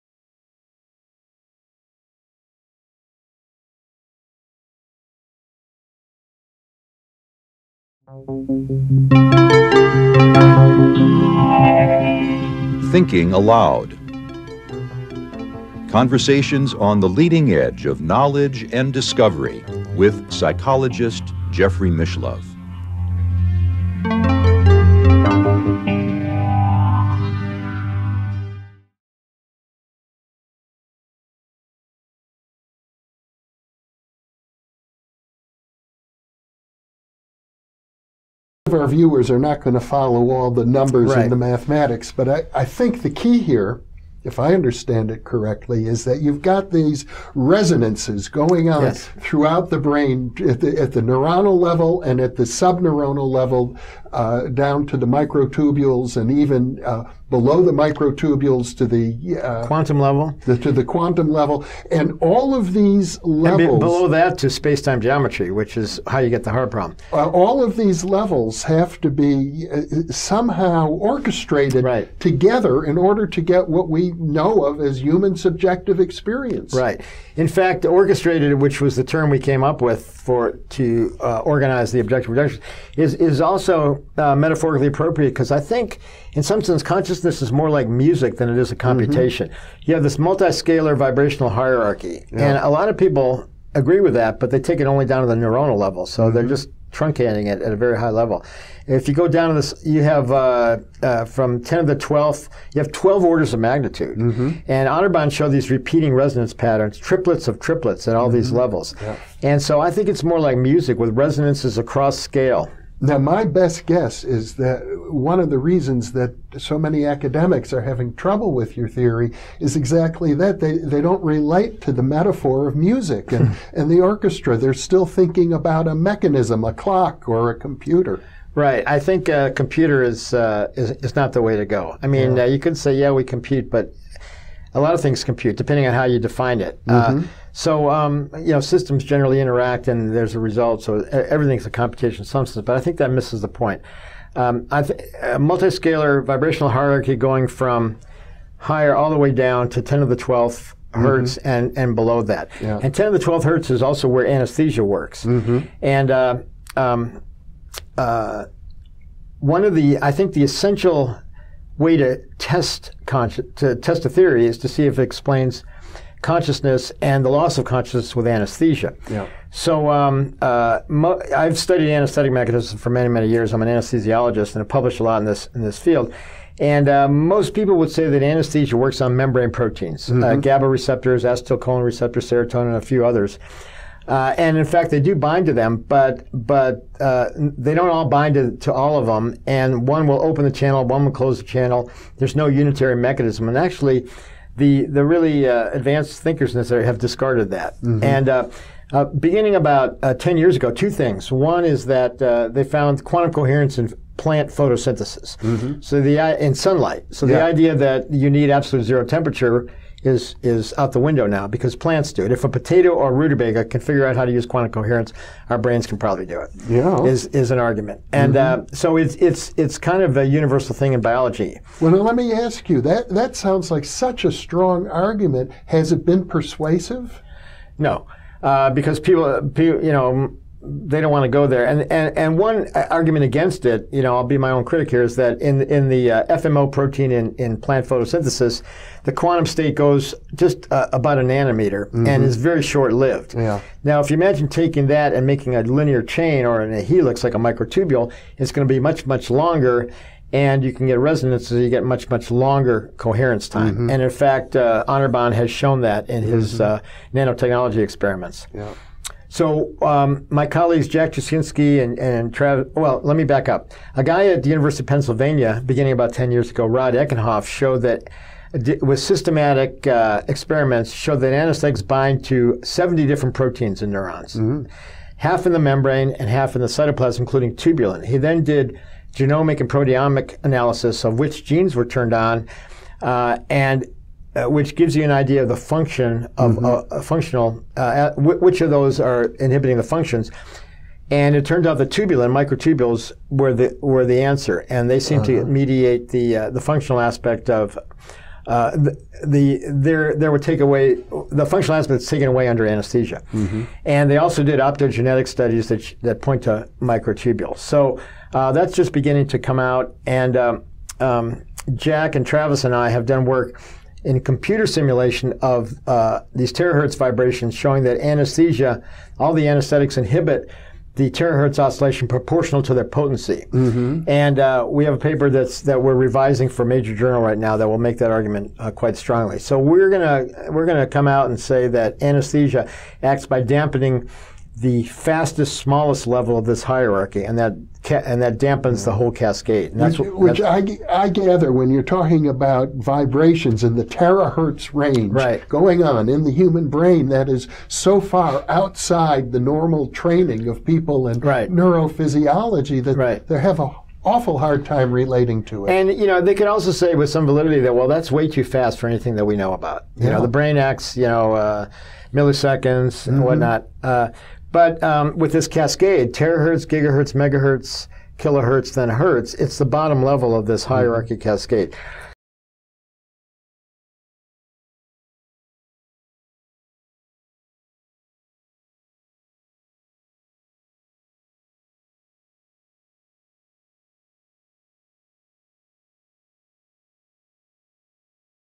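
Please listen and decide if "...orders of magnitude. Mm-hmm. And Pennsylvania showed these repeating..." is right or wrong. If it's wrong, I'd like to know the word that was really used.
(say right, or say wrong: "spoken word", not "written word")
wrong: "Anirban", not "Pennsylvania".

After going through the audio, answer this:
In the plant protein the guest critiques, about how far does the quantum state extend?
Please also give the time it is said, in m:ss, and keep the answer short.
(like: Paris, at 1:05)
about a nanometer, at 4:00.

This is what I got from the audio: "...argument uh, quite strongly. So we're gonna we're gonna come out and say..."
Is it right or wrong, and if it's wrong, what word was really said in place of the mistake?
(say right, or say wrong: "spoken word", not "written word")
right.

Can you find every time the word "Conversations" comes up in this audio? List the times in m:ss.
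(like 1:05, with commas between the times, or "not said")
0:15.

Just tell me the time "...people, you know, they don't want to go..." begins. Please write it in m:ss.
3:49.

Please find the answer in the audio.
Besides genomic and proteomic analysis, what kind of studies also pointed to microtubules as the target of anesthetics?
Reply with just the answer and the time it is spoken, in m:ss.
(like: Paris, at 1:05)
optogenetic studies, at 5:04.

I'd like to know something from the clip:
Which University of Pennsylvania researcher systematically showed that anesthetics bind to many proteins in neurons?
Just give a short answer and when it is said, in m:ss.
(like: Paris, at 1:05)
Rod Eckenhoff, at 4:26.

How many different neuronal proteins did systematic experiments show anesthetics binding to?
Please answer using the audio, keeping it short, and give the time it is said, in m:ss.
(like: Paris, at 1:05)
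70, at 4:32.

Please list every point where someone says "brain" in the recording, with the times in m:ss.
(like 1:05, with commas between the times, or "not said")
0:49, 3:35, 5:46, 6:00.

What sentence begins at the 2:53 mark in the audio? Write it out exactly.
I'm an anesthesiologist and I published a lot in this in this field.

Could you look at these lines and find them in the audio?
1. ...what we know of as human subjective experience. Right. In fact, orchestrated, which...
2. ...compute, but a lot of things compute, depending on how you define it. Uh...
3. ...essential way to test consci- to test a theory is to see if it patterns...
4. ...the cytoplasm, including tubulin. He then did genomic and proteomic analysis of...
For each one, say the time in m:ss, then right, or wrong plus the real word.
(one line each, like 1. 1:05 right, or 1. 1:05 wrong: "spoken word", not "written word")
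1. 1:13 right
2. 2:13 right
3. 2:40 wrong: "explains", not "patterns"
4. 4:36 right.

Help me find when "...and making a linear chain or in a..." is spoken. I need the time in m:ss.
4:05.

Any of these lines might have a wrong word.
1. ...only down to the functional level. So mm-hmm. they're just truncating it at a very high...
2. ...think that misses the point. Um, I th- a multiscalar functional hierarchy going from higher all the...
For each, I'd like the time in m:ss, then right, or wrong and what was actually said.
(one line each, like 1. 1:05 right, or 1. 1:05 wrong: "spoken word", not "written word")
1. 1:34 wrong: "neuronal", not "functional"
2. 2:22 wrong: "vibrational", not "functional".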